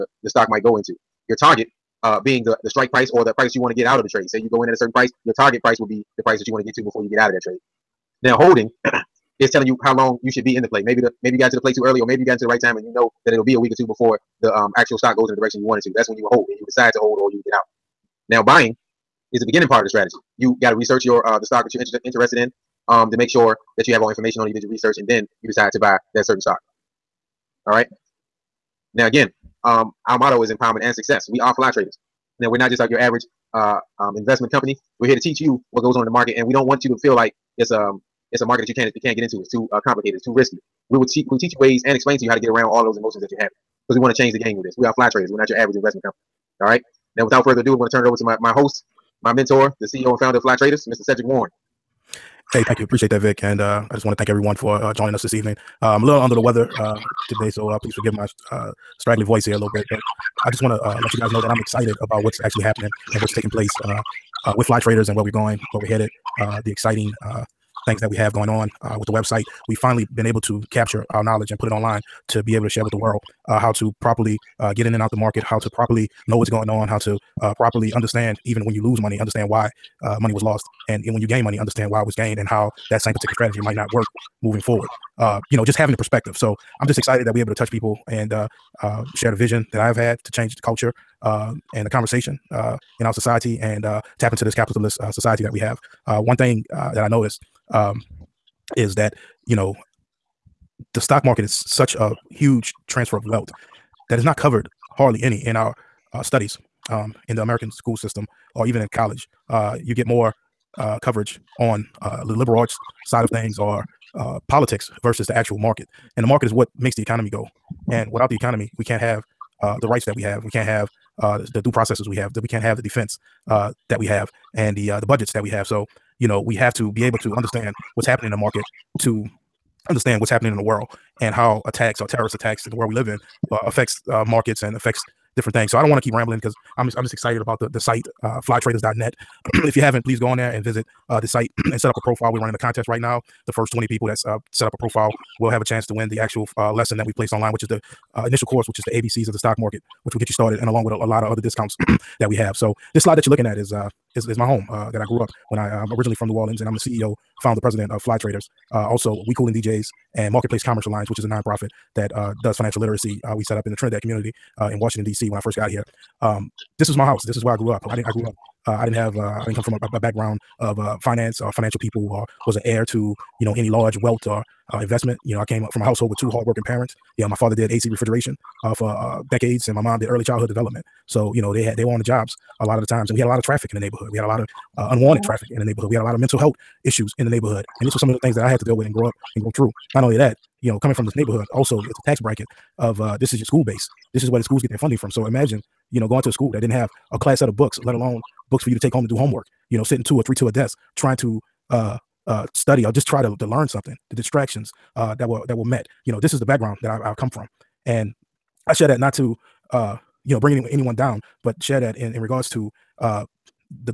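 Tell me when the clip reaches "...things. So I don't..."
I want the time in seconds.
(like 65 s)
135 s.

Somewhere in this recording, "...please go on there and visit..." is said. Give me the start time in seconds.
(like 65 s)
140 s.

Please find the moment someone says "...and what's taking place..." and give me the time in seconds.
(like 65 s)
63 s.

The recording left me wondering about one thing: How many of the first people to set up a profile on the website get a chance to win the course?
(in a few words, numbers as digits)
20.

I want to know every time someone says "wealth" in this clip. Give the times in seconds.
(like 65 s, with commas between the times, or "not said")
103 s, 174 s.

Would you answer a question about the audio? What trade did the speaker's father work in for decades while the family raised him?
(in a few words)
AC refrigeration.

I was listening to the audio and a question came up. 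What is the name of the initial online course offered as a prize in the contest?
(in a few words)
The ABCs of the stock market.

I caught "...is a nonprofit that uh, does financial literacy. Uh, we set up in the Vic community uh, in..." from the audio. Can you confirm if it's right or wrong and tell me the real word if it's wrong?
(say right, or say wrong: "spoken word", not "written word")
wrong: "Trinidad", not "Vic".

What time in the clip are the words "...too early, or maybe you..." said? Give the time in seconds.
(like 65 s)
11 s.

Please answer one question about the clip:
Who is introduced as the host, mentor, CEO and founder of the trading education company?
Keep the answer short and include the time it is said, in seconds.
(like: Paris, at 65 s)
Cedric Warren, at 50 s.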